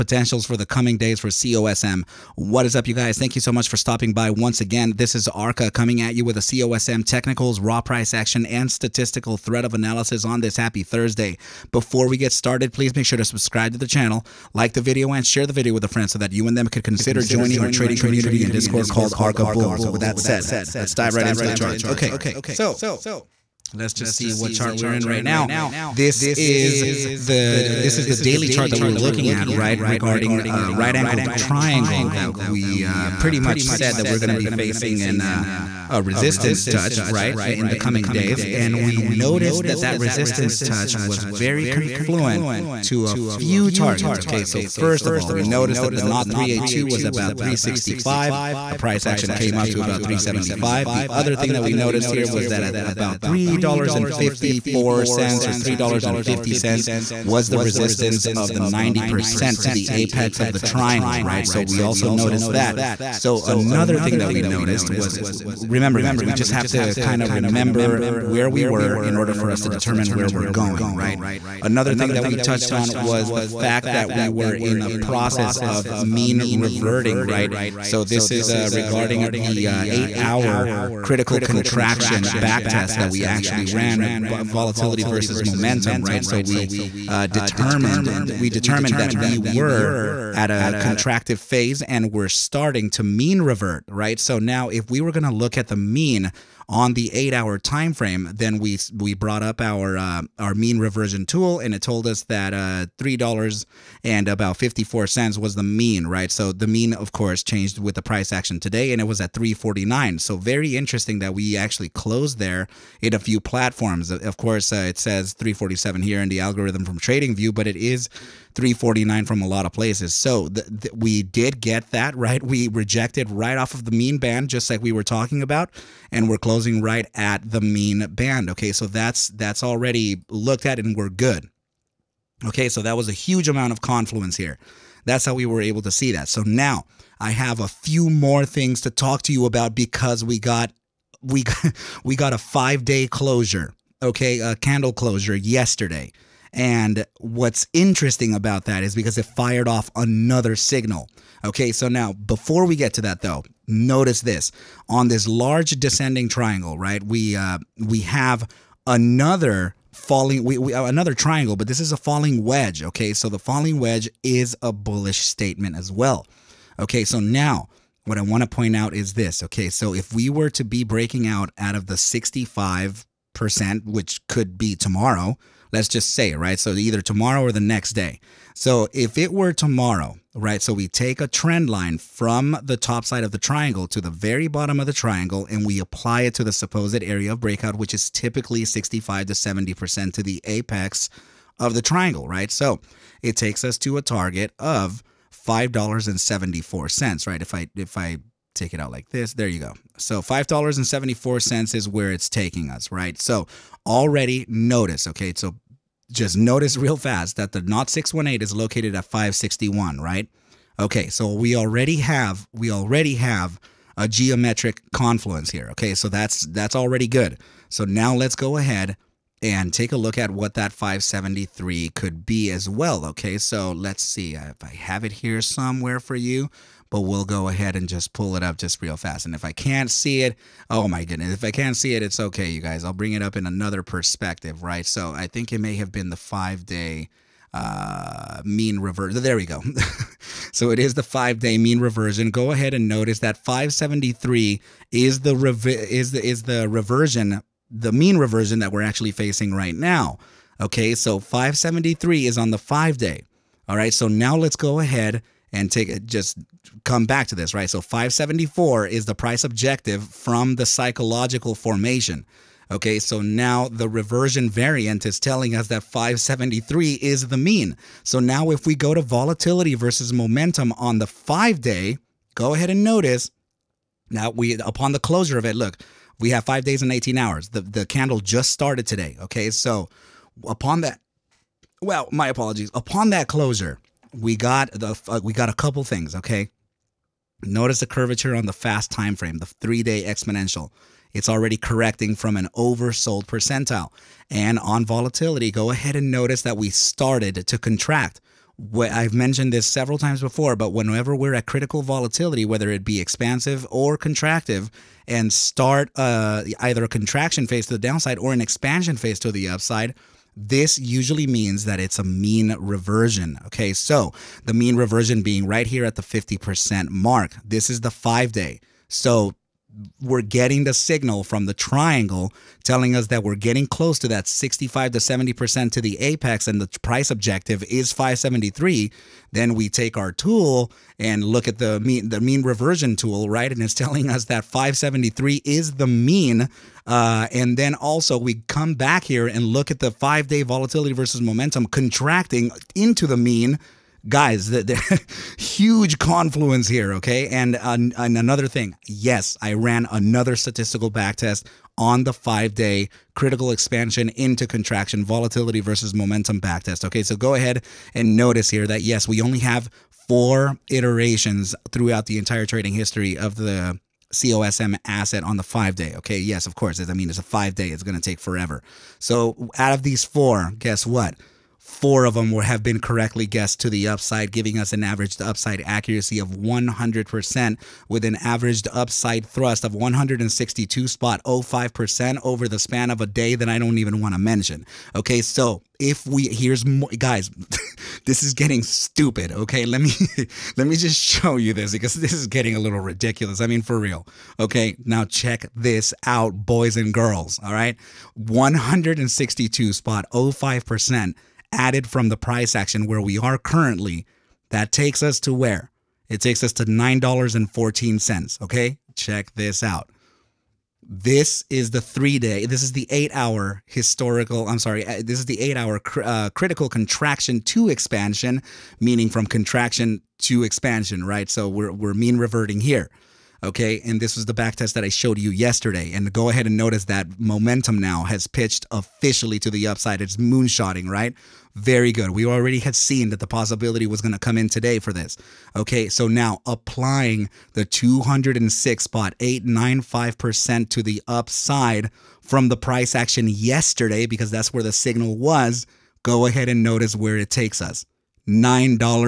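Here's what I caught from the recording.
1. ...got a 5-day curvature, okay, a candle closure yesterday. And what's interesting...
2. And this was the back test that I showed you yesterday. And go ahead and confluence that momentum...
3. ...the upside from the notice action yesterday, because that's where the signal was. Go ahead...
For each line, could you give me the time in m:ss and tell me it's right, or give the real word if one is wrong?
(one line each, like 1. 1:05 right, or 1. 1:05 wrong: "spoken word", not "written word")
1. 2:22 wrong: "closure", not "curvature"
2. 7:03 wrong: "notice", not "confluence"
3. 7:20 wrong: "price", not "notice".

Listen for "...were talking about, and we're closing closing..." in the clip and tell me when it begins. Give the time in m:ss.
2:04.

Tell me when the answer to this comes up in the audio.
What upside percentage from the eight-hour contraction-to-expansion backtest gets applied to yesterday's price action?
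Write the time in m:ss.
7:17.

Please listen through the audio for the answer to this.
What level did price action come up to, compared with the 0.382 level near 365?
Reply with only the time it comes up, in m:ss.
0:50.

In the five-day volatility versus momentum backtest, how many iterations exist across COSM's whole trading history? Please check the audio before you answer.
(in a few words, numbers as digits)
4.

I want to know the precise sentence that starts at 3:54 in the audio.
So I think it may have been the five day uh, mean reversion.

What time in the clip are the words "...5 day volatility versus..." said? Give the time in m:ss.
5:39.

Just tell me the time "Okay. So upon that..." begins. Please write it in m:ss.
4:39.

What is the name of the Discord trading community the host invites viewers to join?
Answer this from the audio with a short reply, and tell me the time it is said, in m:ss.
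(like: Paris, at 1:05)
Arca Bulls, at 0:19.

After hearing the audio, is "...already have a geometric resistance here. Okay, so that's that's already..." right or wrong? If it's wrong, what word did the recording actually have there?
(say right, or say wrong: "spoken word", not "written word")
wrong: "confluence", not "resistance".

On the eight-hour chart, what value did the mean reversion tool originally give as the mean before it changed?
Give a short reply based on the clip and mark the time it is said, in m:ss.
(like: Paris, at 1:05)
$3.54, at 1:42.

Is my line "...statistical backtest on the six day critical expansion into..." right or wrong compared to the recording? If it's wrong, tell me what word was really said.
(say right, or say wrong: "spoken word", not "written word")
wrong: "five", not "six".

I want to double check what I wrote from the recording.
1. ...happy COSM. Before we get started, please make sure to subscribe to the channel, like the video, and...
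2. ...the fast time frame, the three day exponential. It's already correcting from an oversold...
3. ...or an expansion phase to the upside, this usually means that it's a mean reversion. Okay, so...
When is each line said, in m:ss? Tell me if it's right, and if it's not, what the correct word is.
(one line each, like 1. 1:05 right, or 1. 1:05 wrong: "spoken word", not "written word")
1. 0:10 wrong: "Thursday", not "COSM"
2. 4:48 right
3. 5:08 right.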